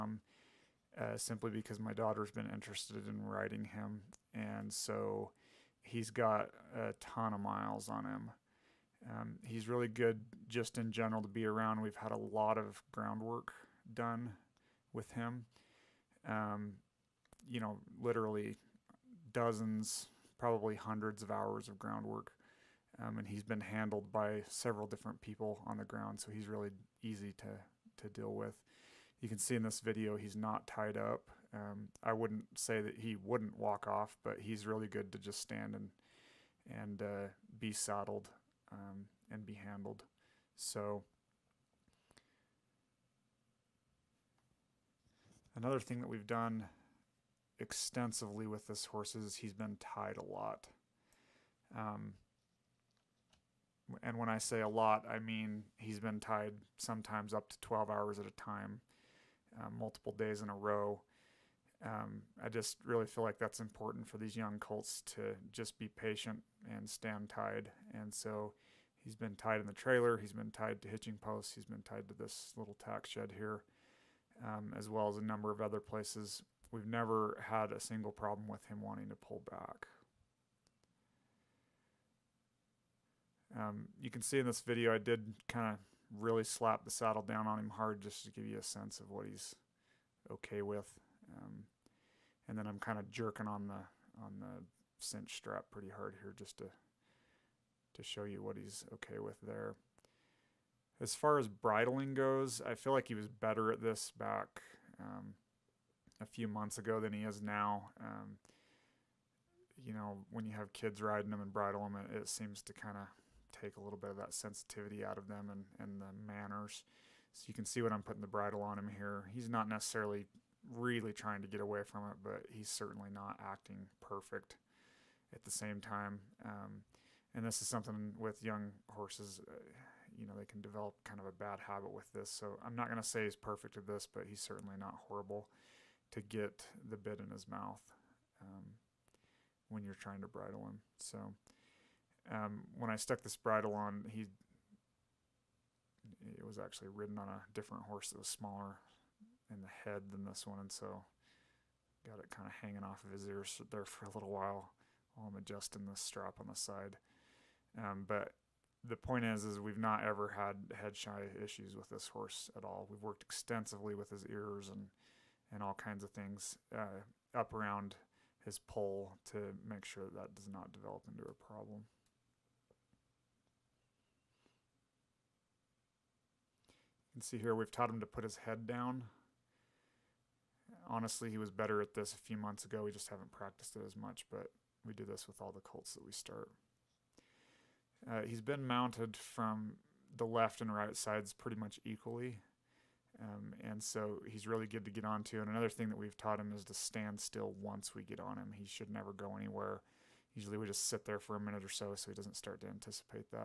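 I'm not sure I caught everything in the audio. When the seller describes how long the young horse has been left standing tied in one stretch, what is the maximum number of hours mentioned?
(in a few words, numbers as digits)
12.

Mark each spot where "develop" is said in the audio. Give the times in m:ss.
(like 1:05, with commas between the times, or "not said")
2:10, 2:50.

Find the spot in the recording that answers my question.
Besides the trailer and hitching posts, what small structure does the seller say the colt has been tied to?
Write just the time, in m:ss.
1:12.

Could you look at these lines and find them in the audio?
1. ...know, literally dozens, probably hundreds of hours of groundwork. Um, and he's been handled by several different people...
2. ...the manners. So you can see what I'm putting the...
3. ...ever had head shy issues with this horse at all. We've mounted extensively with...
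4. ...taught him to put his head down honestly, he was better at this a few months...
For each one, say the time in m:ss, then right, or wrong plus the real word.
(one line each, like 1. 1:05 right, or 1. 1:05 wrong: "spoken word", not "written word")
1. 0:17 right
2. 1:56 right
3. 2:40 wrong: "worked", not "mounted"
4. 2:57 right.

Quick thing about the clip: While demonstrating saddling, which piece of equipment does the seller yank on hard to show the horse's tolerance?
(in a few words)
cinch strap.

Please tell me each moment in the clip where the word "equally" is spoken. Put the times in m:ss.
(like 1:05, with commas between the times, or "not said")
3:11.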